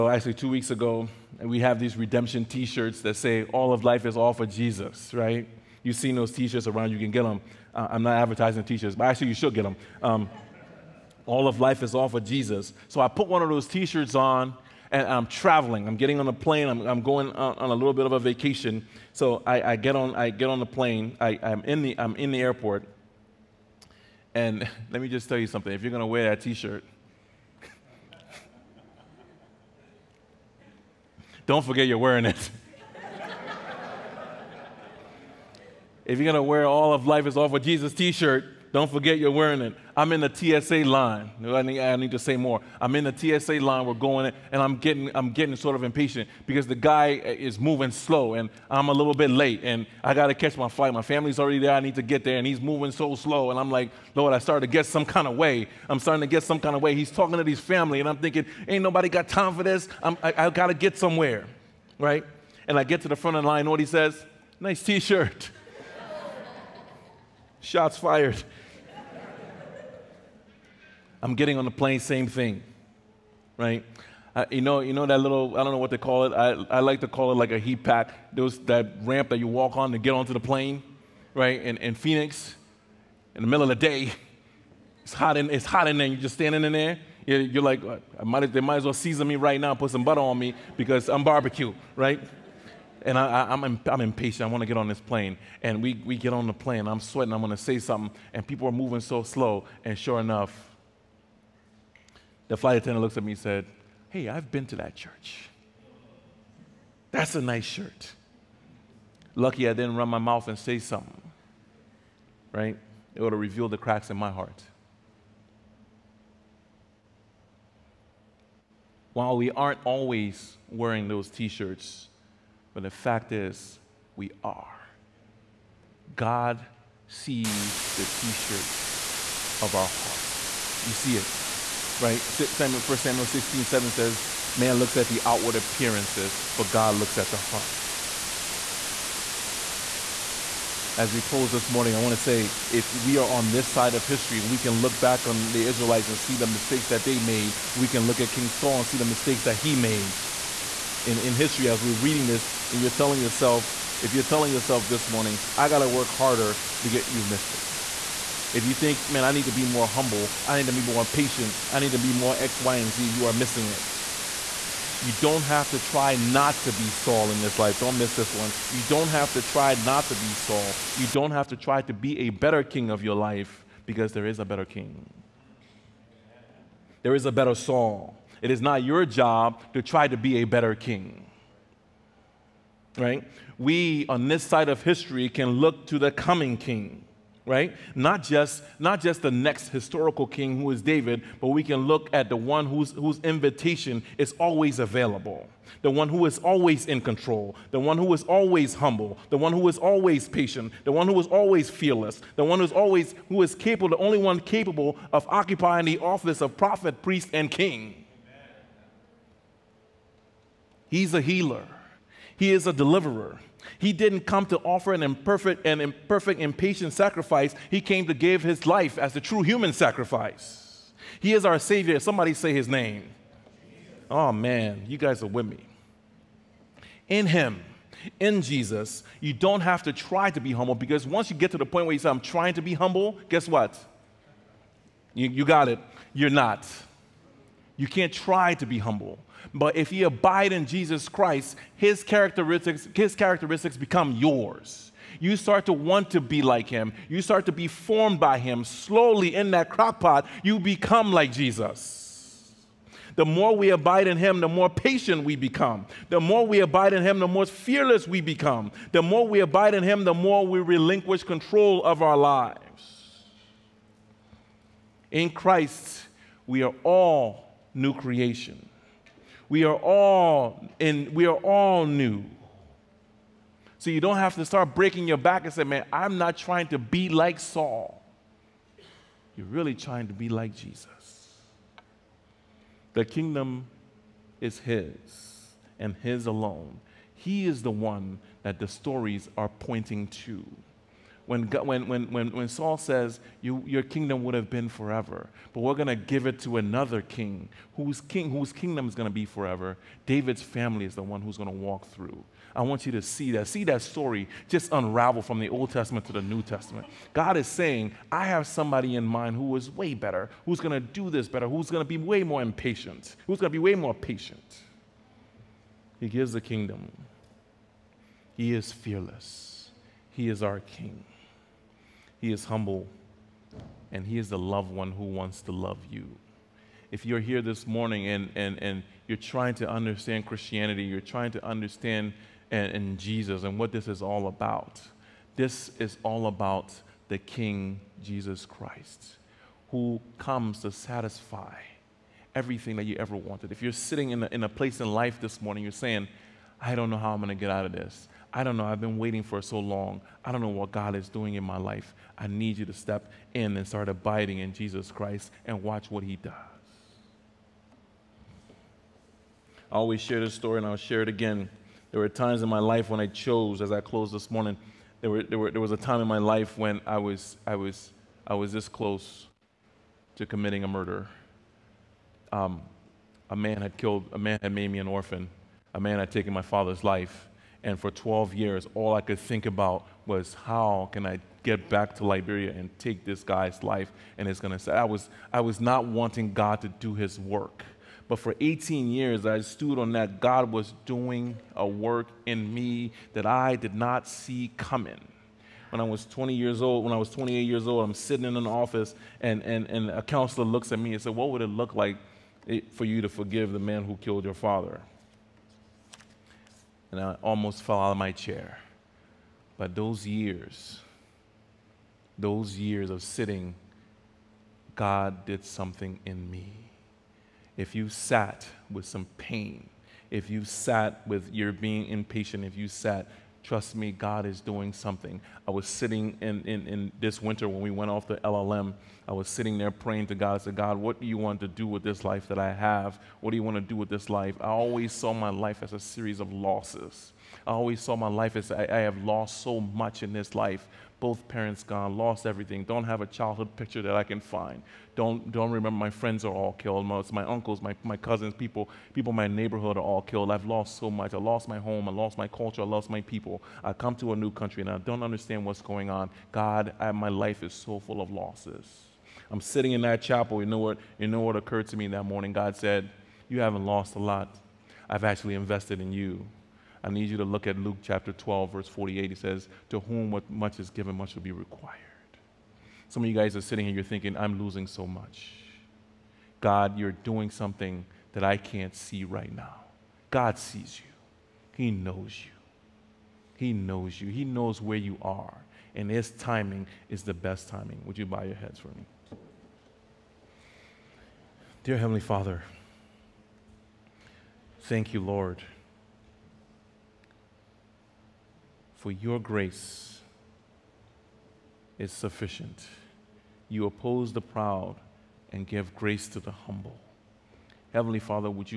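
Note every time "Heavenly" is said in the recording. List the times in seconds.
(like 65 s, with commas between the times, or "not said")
491 s, 507 s.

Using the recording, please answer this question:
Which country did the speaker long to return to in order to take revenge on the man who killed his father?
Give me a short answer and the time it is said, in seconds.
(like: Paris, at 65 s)
Liberia, at 382 s.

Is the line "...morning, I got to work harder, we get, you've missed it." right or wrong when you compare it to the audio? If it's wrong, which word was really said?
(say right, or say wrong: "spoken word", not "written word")
right.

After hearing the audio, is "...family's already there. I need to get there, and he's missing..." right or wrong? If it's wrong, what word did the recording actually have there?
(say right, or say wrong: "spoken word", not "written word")
wrong: "moving", not "missing".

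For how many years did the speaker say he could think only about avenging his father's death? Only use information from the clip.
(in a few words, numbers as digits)
12.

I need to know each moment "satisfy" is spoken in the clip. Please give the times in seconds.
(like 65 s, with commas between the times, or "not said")
340 s.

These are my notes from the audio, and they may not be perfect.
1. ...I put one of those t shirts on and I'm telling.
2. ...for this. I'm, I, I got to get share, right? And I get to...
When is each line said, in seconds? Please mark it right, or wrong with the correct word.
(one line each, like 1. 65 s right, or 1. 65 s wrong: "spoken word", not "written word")
1. 13 s wrong: "traveling", not "telling"
2. 59 s wrong: "somewhere", not "share".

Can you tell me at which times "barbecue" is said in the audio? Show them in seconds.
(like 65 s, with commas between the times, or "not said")
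91 s.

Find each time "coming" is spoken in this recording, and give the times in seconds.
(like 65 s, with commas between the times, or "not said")
186 s, 394 s.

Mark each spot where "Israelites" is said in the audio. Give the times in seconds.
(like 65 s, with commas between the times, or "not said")
145 s.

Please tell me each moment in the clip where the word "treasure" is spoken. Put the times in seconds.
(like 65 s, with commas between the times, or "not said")
not said.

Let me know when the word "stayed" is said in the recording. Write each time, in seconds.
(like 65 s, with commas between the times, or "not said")
not said.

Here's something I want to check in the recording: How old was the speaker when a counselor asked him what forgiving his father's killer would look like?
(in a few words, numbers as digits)
28.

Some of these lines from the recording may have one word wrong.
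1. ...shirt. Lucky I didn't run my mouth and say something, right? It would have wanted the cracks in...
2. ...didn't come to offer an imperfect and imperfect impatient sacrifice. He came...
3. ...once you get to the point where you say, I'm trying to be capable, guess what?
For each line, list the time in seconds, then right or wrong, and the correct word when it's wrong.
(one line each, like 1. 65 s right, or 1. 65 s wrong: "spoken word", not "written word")
1. 107 s wrong: "revealed", not "wanted"
2. 213 s right
3. 231 s wrong: "humble", not "capable".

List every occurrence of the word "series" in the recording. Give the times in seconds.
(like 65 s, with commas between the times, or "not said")
435 s.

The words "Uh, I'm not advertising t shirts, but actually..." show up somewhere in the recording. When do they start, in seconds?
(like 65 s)
7 s.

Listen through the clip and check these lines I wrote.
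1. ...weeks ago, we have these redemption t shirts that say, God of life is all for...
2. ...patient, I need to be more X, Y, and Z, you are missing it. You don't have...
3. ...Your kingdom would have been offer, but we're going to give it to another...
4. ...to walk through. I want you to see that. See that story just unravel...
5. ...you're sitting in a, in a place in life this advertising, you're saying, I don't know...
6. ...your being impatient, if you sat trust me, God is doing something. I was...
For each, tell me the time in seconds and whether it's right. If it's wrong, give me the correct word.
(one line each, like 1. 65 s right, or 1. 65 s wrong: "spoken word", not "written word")
1. 0 s wrong: "All", not "God"
2. 161 s right
3. 293 s wrong: "forever", not "offer"
4. 301 s right
5. 343 s wrong: "morning", not "advertising"
6. 421 s right.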